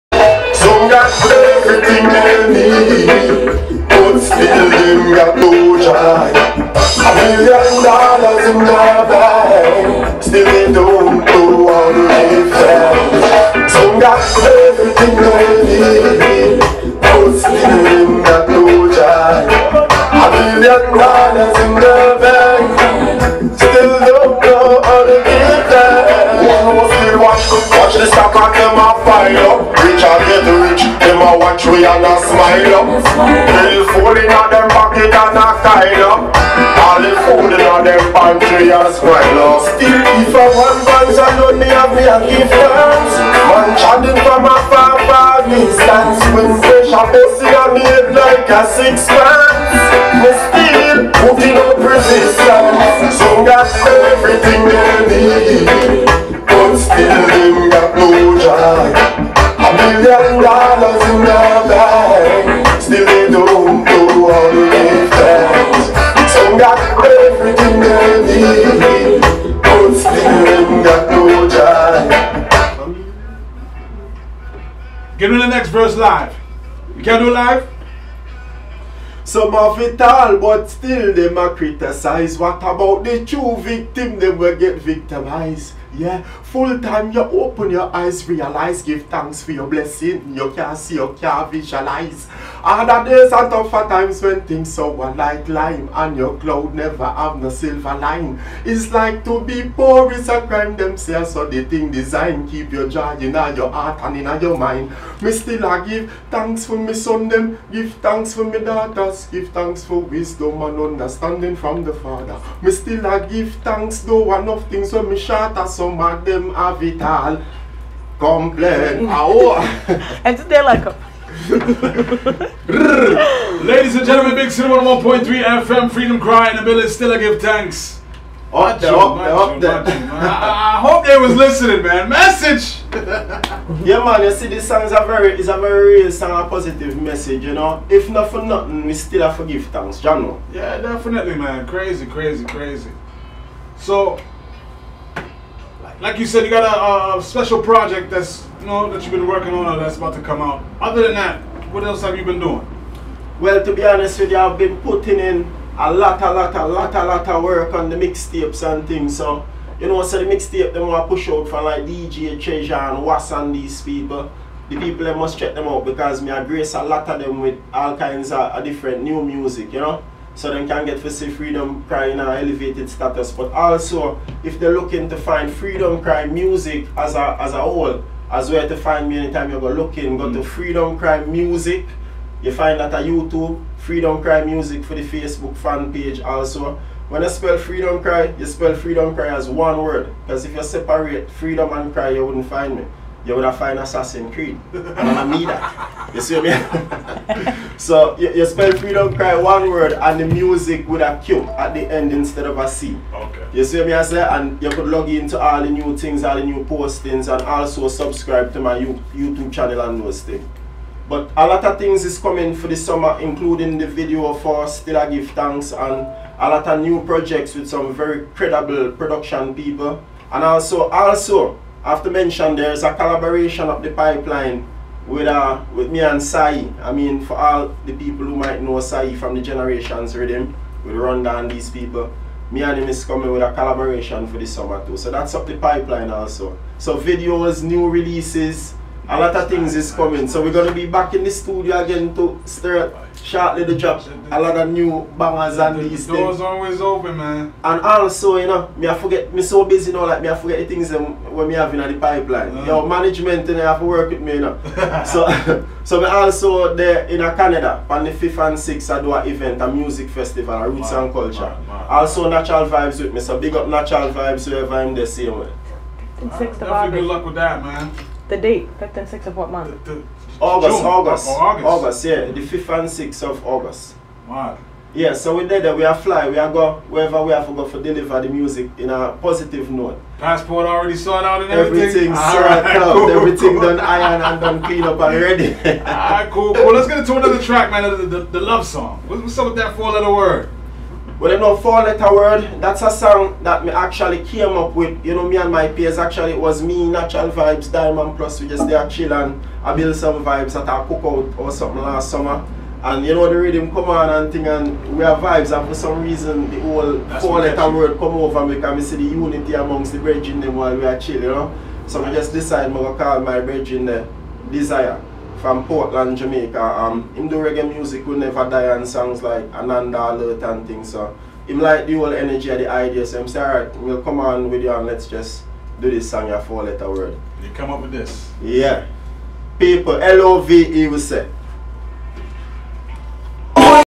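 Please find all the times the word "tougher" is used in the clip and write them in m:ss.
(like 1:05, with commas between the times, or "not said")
1:33.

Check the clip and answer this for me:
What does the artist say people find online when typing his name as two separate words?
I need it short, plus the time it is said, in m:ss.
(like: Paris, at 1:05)
Assassin's Creed, at 3:13.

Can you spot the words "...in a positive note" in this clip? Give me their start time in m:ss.
4:38.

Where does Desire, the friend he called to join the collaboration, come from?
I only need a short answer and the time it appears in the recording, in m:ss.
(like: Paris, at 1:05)
Portland, Jamaica, at 5:15.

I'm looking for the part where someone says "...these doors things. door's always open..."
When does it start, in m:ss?
4:05.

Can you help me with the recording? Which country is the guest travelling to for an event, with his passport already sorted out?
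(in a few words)
Canada.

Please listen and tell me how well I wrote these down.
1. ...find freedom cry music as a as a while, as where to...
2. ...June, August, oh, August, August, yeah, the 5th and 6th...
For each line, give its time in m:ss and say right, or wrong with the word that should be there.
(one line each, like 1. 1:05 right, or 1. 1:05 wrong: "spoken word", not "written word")
1. 2:55 wrong: "whole", not "while"
2. 4:30 right.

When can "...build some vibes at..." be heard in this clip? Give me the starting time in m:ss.
4:59.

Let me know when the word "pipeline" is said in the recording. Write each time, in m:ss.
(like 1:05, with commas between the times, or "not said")
3:43, 3:55, 4:11.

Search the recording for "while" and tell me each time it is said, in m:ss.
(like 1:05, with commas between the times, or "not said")
5:10.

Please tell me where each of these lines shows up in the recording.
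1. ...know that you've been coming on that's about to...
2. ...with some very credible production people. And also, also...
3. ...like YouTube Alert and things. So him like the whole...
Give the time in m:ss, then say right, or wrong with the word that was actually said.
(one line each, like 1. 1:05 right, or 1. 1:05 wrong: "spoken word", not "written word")
1. 2:28 wrong: "working", not "coming"
2. 3:37 right
3. 5:19 wrong: "Ananda", not "YouTube".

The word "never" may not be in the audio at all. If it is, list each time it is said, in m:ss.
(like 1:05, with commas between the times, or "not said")
1:36, 5:18.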